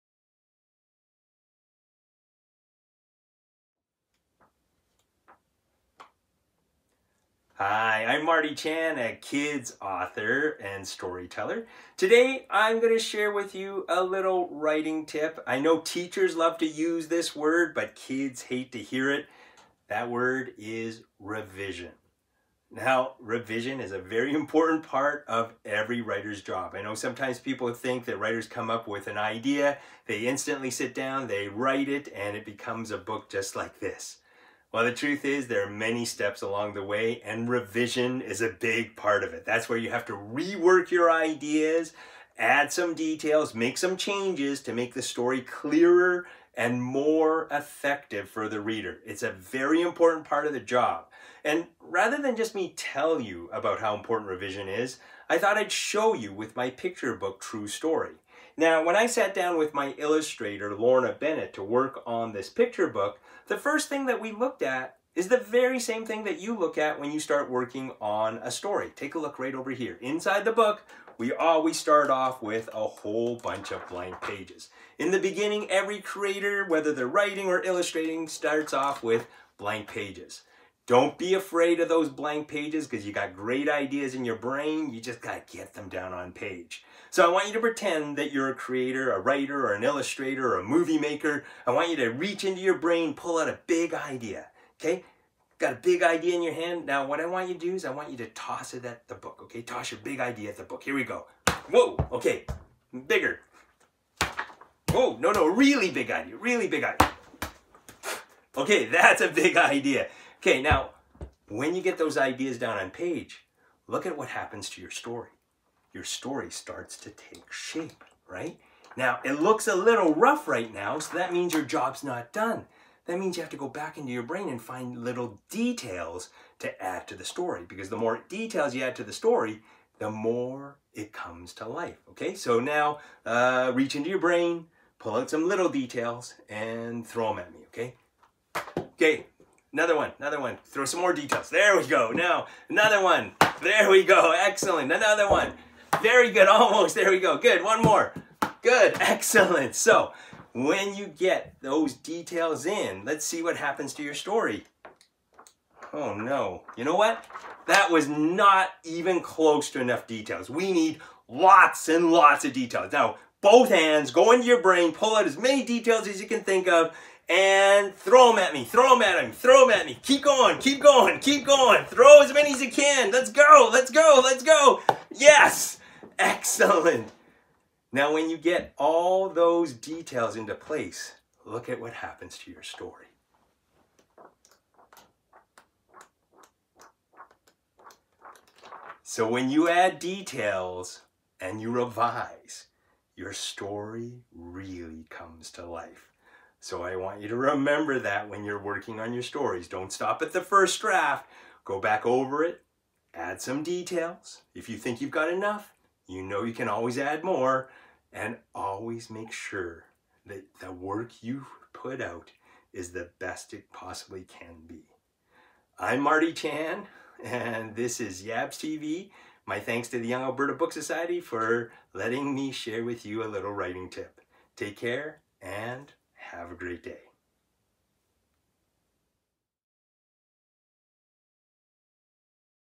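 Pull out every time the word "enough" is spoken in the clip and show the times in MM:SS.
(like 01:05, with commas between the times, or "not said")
02:39, 03:25.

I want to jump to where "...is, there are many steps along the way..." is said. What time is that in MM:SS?
00:35.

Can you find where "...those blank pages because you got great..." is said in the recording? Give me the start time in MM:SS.
01:21.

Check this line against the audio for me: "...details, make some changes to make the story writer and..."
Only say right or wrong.
wrong.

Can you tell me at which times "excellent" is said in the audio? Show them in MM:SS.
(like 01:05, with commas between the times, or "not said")
02:24, 02:28, 02:56.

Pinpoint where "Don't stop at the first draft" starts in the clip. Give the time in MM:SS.
03:19.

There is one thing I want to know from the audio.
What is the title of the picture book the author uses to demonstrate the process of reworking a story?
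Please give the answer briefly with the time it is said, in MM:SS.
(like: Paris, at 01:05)
True Story, at 00:57.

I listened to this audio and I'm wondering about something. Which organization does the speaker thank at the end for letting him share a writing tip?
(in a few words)
Young Alberta Book Society.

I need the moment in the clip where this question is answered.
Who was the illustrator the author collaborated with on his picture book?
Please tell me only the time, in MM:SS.
01:00.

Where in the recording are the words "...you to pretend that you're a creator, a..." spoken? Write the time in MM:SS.
01:27.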